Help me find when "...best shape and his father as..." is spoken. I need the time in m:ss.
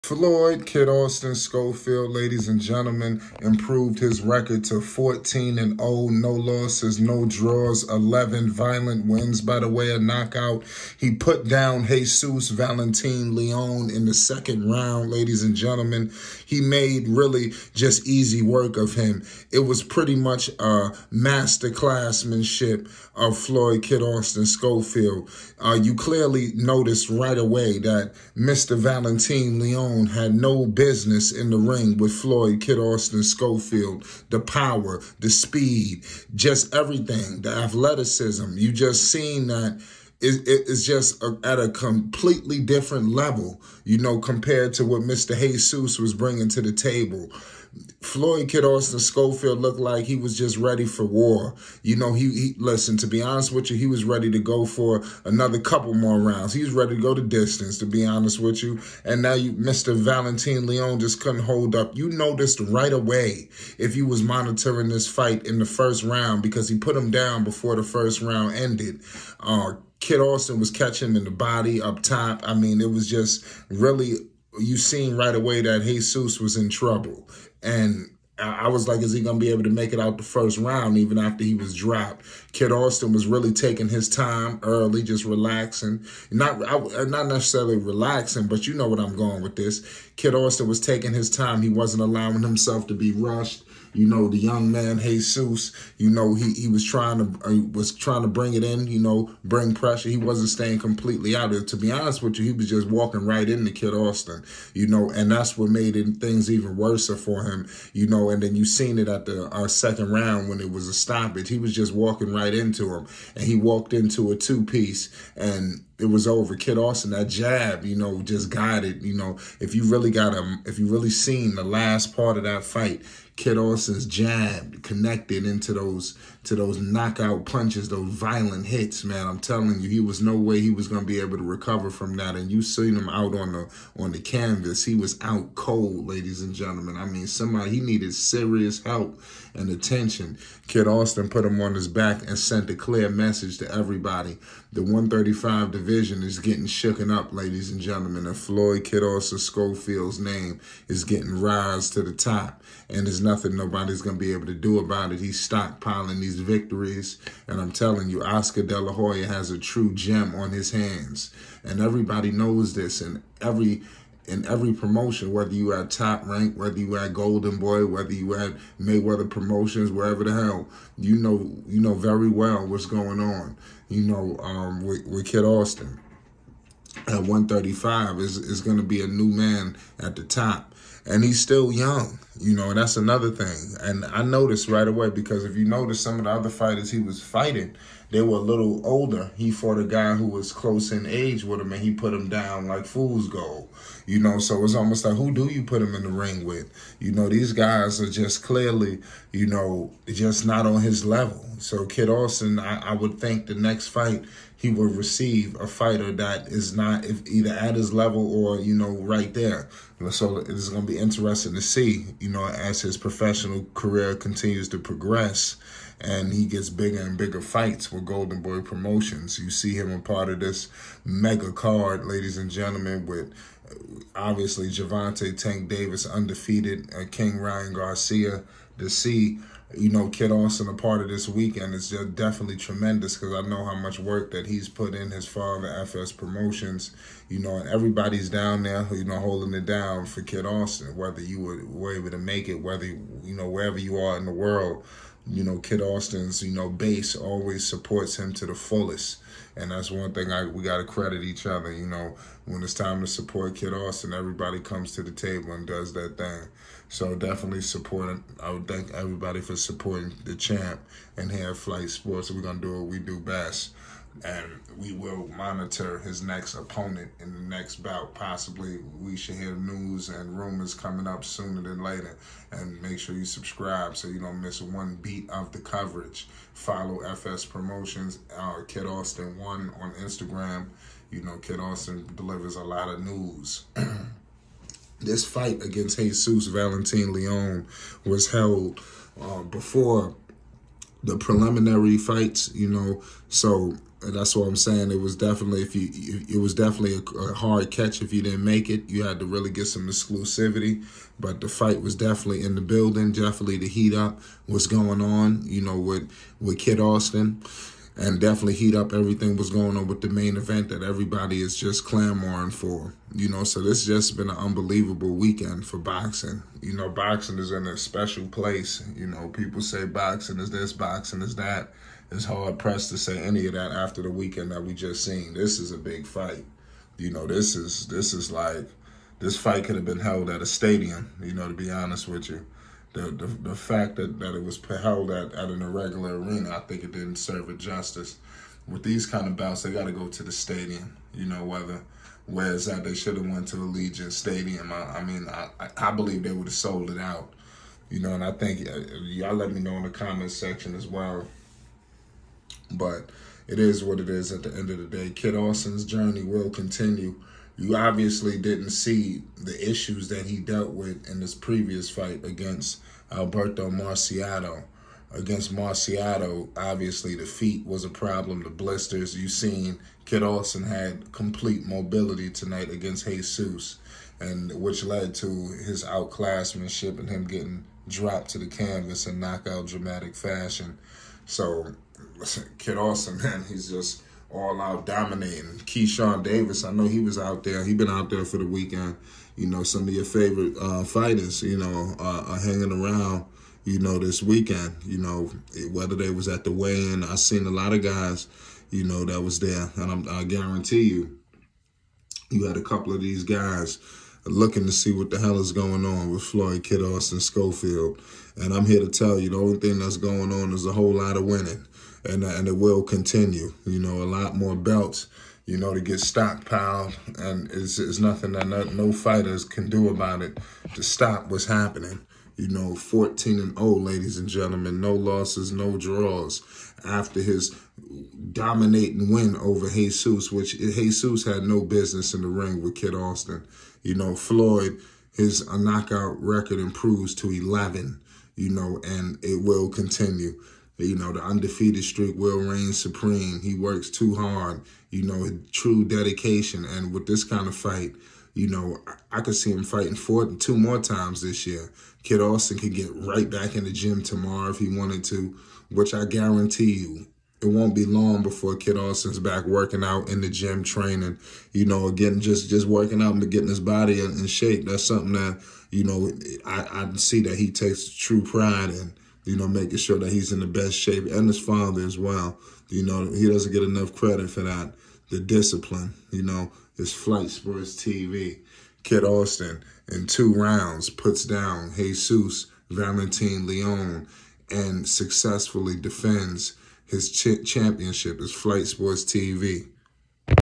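7:50.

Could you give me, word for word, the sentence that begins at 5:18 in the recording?
You know, people say boxing is this, boxing is that.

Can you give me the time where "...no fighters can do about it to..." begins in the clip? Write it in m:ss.
6:58.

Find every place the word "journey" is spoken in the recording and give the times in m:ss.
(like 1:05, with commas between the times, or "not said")
5:55.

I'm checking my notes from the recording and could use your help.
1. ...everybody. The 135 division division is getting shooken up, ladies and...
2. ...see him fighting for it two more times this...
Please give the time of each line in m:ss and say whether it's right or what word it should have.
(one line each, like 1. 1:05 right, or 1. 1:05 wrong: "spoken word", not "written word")
1. 2:23 right
2. 7:29 right.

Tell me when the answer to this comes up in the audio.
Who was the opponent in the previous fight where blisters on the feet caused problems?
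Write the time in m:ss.
6:03.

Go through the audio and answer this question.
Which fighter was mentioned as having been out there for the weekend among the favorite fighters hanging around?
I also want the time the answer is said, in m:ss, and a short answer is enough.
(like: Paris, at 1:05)
Keyshawn Davis, at 6:25.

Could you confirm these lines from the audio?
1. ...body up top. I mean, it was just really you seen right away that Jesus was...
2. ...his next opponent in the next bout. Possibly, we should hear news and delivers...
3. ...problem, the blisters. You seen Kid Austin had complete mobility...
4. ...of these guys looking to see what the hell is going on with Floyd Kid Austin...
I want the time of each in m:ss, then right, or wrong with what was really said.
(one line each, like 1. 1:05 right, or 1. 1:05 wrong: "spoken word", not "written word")
1. 1:11 right
2. 4:25 wrong: "rumors", not "delivers"
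3. 6:07 right
4. 6:42 right.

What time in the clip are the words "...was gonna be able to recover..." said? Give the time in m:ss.
2:10.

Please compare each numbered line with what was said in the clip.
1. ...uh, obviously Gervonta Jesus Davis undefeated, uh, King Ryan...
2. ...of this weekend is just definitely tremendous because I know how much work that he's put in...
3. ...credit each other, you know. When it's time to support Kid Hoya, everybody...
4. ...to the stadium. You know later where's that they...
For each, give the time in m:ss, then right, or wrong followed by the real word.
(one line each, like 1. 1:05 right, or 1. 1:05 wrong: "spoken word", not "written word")
1. 3:43 wrong: "Tank", not "Jesus"
2. 3:50 right
3. 4:10 wrong: "Austin", not "Hoya"
4. 5:40 wrong: "whether", not "later".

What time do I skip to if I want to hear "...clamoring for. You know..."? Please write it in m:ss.
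5:11.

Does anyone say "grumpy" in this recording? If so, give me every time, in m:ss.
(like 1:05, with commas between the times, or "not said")
not said.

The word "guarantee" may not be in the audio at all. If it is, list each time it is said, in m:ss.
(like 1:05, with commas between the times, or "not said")
6:40, 7:36.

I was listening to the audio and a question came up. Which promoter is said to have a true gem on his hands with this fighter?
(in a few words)
Oscar De La Hoya.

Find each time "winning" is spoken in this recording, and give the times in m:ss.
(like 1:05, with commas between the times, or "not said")
6:51.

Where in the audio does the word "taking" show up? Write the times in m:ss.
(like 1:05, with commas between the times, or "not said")
1:23, 1:30.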